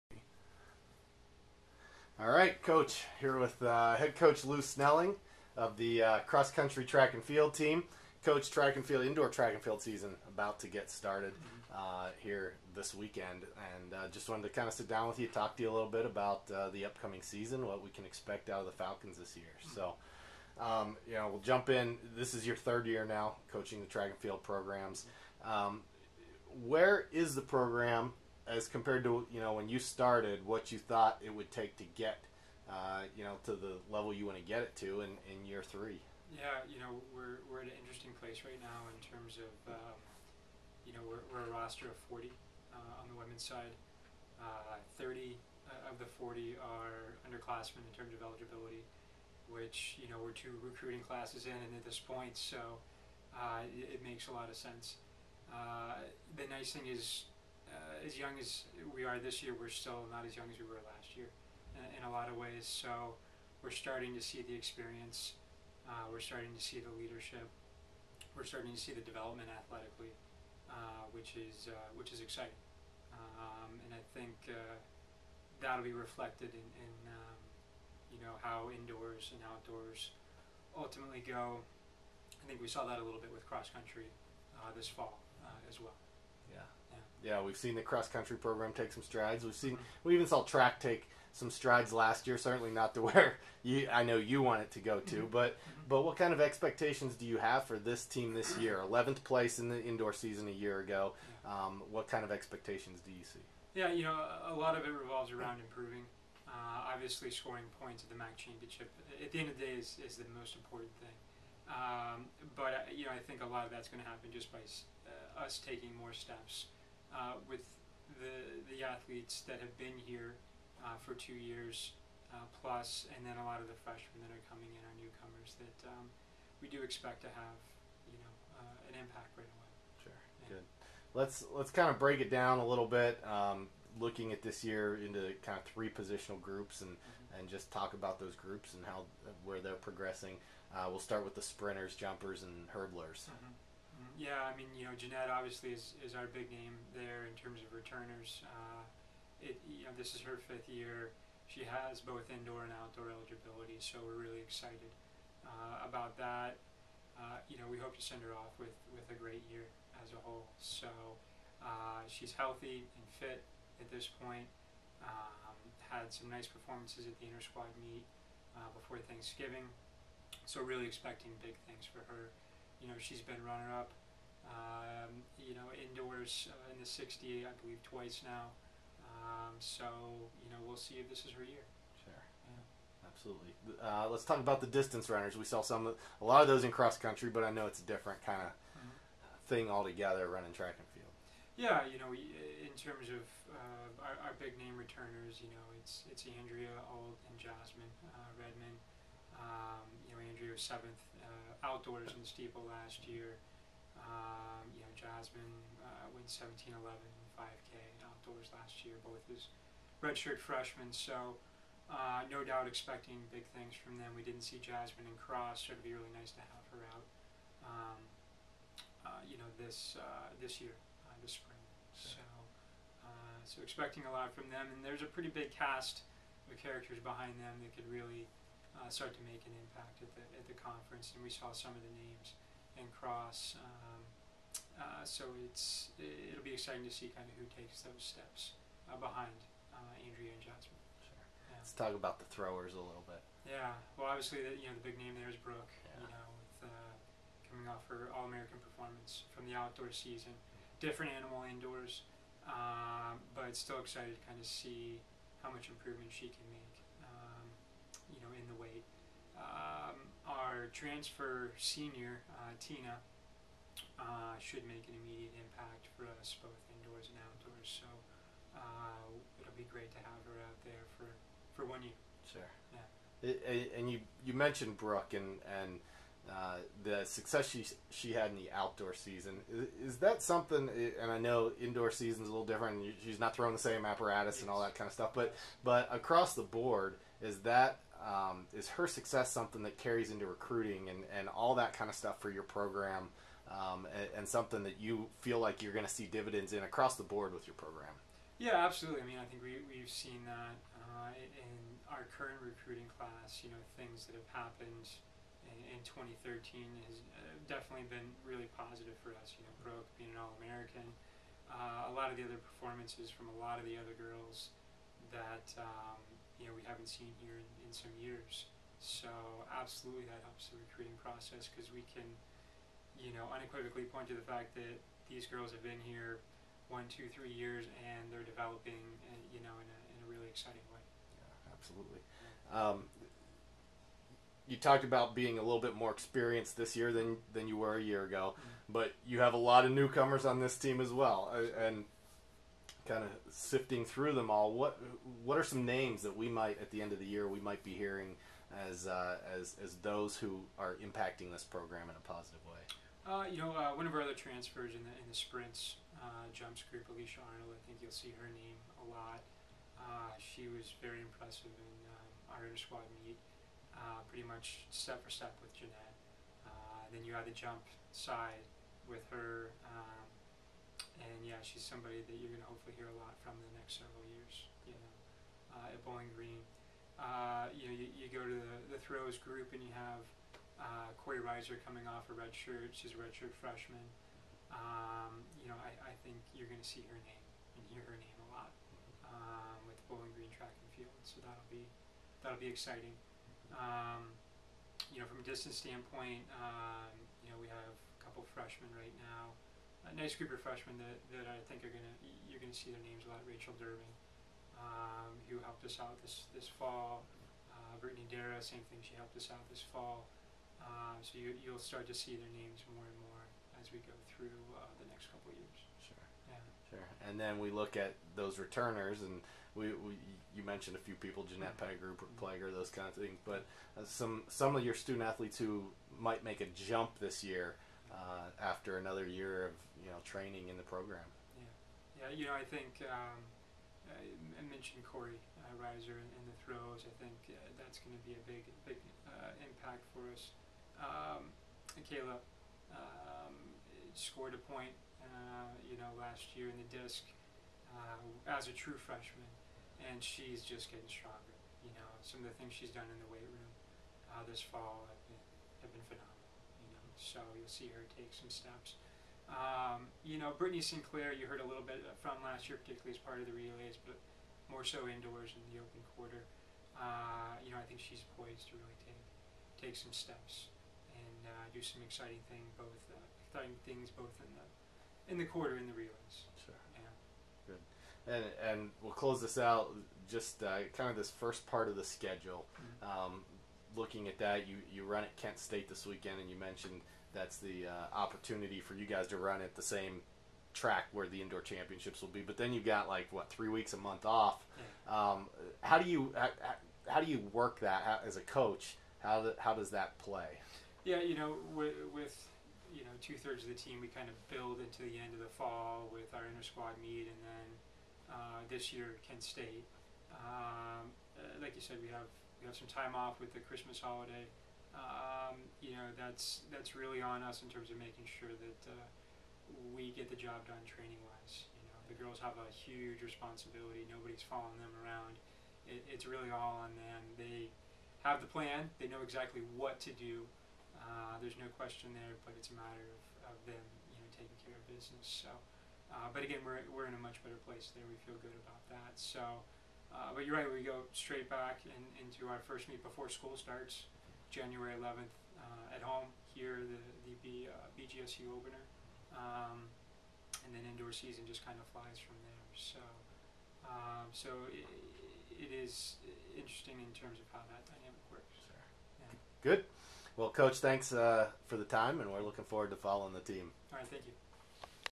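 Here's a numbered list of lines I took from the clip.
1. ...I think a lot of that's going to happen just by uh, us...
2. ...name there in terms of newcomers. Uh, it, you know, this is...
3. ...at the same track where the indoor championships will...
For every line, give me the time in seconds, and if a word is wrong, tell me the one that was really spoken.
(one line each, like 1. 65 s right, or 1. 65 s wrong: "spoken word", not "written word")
1. 113 s right
2. 146 s wrong: "returners", not "newcomers"
3. 489 s right.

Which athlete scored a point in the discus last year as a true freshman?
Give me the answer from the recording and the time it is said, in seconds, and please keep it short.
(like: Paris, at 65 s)
Caleb, at 441 s.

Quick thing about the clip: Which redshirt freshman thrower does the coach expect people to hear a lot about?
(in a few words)
Corey Reiser.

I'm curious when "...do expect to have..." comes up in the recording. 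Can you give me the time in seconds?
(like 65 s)
126 s.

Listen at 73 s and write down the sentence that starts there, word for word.
Um, and I think uh, that'll be reflected in, in um, you know how indoors and outdoors ultimately go.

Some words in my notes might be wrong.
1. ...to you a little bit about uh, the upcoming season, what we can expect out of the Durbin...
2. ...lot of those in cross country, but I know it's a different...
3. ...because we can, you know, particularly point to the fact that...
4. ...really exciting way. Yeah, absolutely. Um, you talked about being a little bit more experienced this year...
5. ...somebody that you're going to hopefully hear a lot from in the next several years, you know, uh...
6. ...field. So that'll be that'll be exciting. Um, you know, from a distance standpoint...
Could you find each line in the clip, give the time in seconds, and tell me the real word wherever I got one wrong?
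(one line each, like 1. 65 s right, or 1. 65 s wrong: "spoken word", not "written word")
1. 15 s wrong: "Falcons", not "Durbin"
2. 186 s right
3. 321 s wrong: "unequivocally", not "particularly"
4. 330 s right
5. 371 s right
6. 390 s right.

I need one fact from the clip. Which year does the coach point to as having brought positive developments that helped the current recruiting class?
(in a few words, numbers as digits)
2013.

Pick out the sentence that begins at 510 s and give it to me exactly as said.
Um, uh, like you said, we have we have some time off with the Christmas holiday.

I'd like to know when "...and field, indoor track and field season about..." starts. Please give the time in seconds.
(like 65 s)
8 s.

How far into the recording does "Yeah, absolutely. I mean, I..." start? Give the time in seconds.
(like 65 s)
298 s.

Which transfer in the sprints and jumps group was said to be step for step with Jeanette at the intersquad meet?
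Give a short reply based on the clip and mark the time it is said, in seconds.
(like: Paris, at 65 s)
Alicia Arnold, at 356 s.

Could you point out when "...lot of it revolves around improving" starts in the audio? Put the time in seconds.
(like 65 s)
104 s.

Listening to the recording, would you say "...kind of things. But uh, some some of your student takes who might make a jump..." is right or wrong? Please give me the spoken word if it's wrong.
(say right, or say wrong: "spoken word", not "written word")
wrong: "athletes", not "takes".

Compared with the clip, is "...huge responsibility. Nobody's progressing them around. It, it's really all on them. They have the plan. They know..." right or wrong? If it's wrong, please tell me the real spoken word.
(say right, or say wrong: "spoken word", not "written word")
wrong: "following", not "progressing".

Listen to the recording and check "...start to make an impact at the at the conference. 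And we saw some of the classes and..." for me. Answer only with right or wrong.
wrong.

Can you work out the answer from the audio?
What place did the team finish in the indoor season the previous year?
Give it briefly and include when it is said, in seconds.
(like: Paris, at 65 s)
Eleventh, at 98 s.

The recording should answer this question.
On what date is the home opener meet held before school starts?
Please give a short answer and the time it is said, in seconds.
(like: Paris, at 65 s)
January 11, at 544 s.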